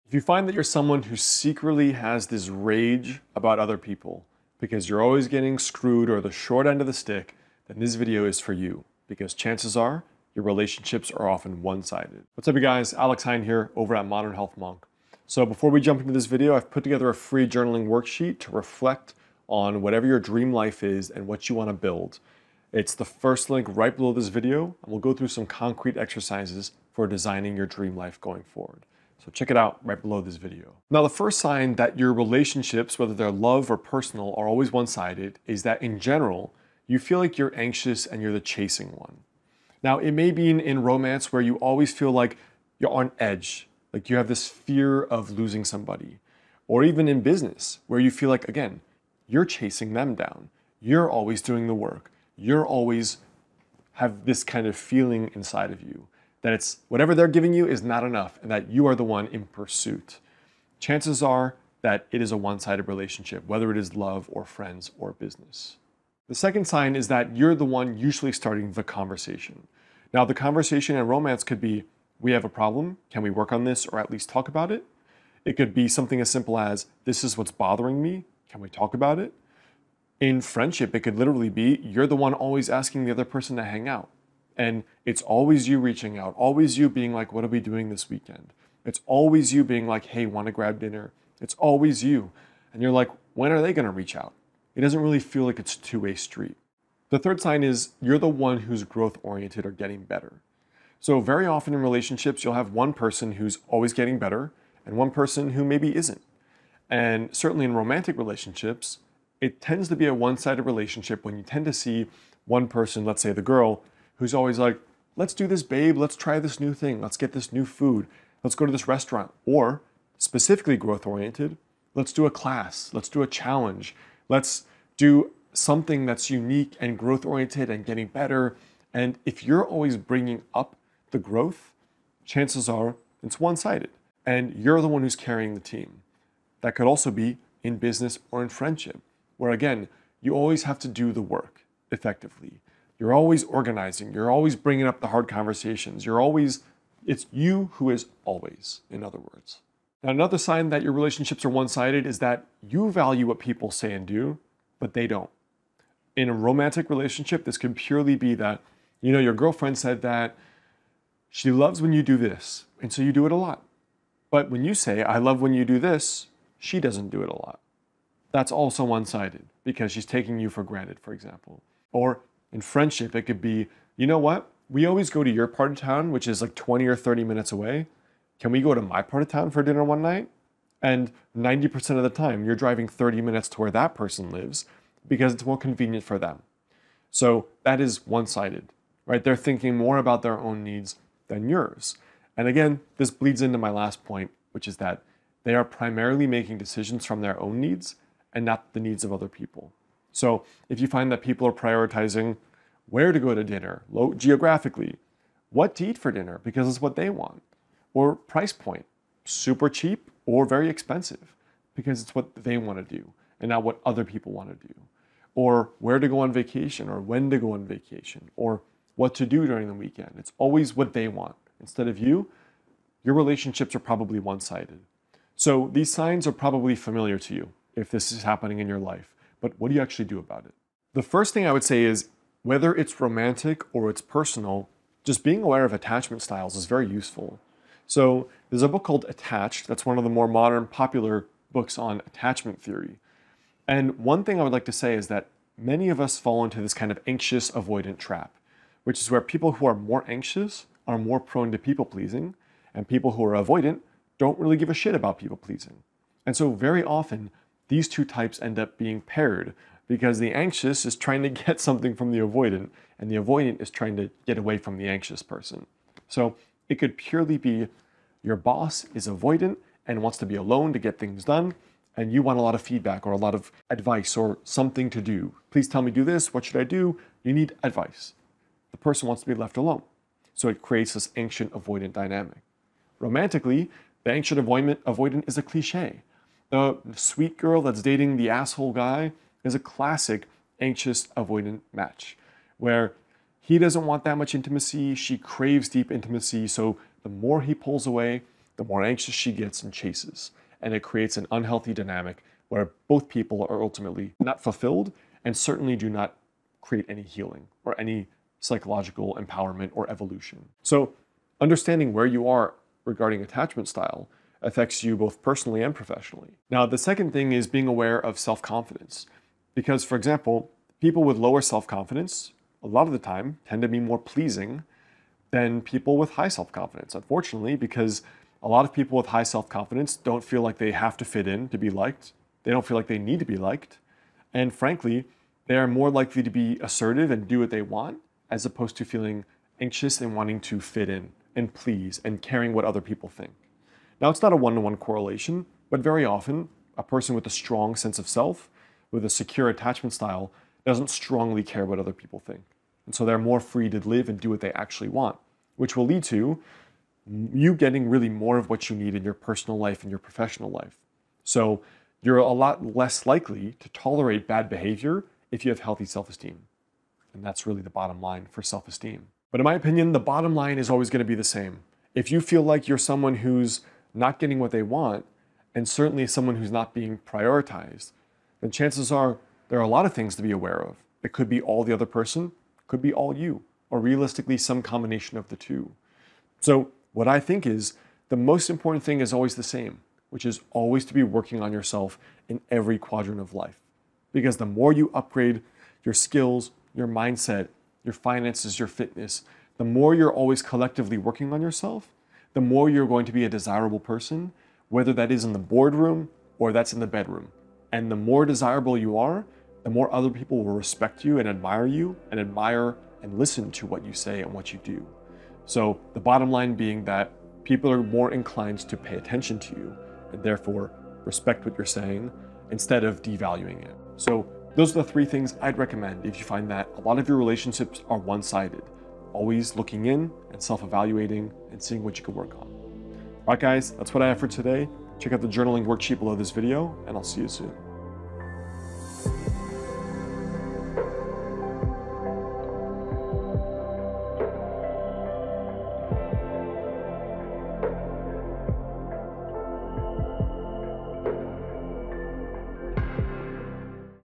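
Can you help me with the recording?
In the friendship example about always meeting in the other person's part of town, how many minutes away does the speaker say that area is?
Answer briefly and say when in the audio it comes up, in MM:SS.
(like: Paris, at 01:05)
20 or 30, at 02:56.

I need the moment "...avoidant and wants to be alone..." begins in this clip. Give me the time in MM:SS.
04:29.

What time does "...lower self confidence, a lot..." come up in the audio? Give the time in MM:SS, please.
05:21.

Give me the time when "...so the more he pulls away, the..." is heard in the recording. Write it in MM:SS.
04:56.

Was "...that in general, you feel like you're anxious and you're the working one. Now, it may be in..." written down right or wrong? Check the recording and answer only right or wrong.
wrong.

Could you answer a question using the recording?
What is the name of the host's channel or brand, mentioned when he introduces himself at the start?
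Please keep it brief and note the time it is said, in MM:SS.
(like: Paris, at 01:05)
Modern Health Monk, at 00:14.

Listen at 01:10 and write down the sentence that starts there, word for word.
Now, the conversation in romance could be we have a problem, can we work on this or at least talk about it?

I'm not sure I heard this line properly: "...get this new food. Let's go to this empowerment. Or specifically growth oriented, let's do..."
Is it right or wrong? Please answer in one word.
wrong.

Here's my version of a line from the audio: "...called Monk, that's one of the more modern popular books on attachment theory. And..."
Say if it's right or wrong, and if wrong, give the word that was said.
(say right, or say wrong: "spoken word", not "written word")
wrong: "Attached", not "Monk".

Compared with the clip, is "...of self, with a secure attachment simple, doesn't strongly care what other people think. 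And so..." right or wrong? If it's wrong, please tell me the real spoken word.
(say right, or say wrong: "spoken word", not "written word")
wrong: "style", not "simple".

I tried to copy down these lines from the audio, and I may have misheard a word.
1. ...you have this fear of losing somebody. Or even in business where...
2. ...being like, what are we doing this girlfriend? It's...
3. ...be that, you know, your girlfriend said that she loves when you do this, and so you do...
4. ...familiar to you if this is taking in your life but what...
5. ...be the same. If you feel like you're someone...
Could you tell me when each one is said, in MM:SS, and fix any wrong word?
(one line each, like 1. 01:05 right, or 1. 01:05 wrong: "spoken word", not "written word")
1. 00:44 right
2. 01:26 wrong: "weekend", not "girlfriend"
3. 02:38 right
4. 03:46 wrong: "happening", not "taking"
5. 06:11 right.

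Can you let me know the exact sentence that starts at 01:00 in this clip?
Chances are that it is a one sided relationship, whether it is love or friends or business.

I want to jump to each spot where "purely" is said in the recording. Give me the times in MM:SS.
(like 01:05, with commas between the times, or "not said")
02:37, 04:26.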